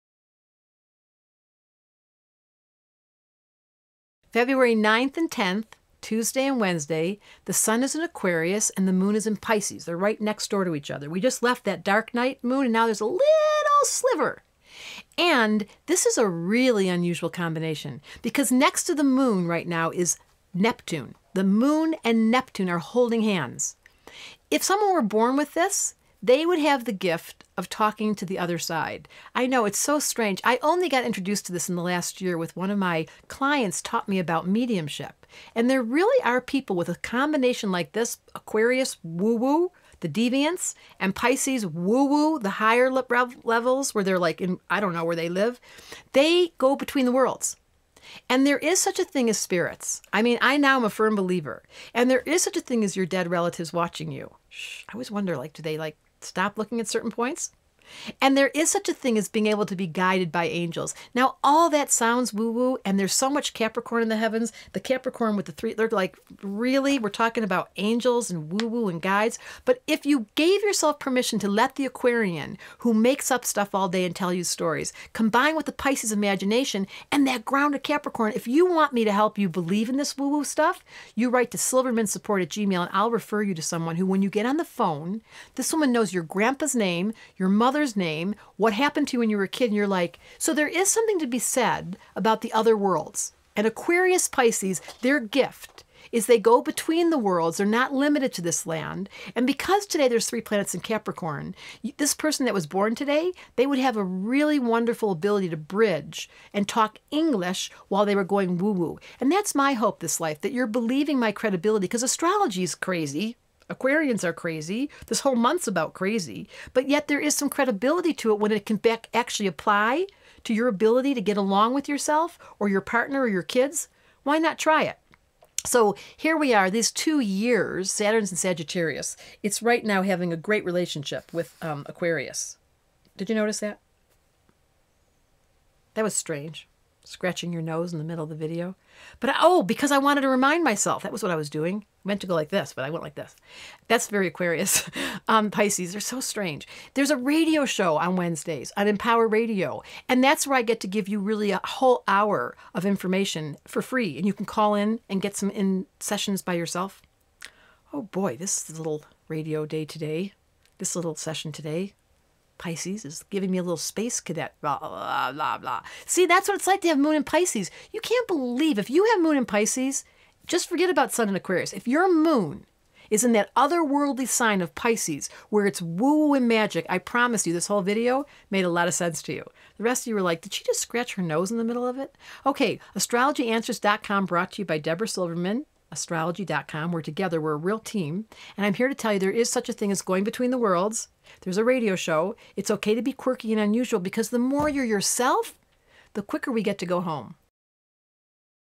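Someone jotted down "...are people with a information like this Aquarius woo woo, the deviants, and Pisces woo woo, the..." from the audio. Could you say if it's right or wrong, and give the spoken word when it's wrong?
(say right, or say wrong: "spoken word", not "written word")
wrong: "combination", not "information".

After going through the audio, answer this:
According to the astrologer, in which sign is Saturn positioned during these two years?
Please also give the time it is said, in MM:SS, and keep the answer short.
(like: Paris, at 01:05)
Sagittarius, at 02:08.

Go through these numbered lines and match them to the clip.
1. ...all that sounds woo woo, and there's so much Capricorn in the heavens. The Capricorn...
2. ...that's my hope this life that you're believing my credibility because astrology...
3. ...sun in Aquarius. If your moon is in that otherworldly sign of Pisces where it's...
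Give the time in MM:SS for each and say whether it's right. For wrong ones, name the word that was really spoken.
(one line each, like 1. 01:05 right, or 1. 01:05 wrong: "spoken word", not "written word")
1. 01:01 right
2. 01:49 right
3. 02:51 right.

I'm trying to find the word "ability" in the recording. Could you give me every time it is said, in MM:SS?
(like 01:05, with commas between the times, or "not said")
01:45, 02:00.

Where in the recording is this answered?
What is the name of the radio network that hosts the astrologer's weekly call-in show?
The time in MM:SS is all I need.
02:28.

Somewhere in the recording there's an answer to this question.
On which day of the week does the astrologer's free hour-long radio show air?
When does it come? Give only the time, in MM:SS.
02:28.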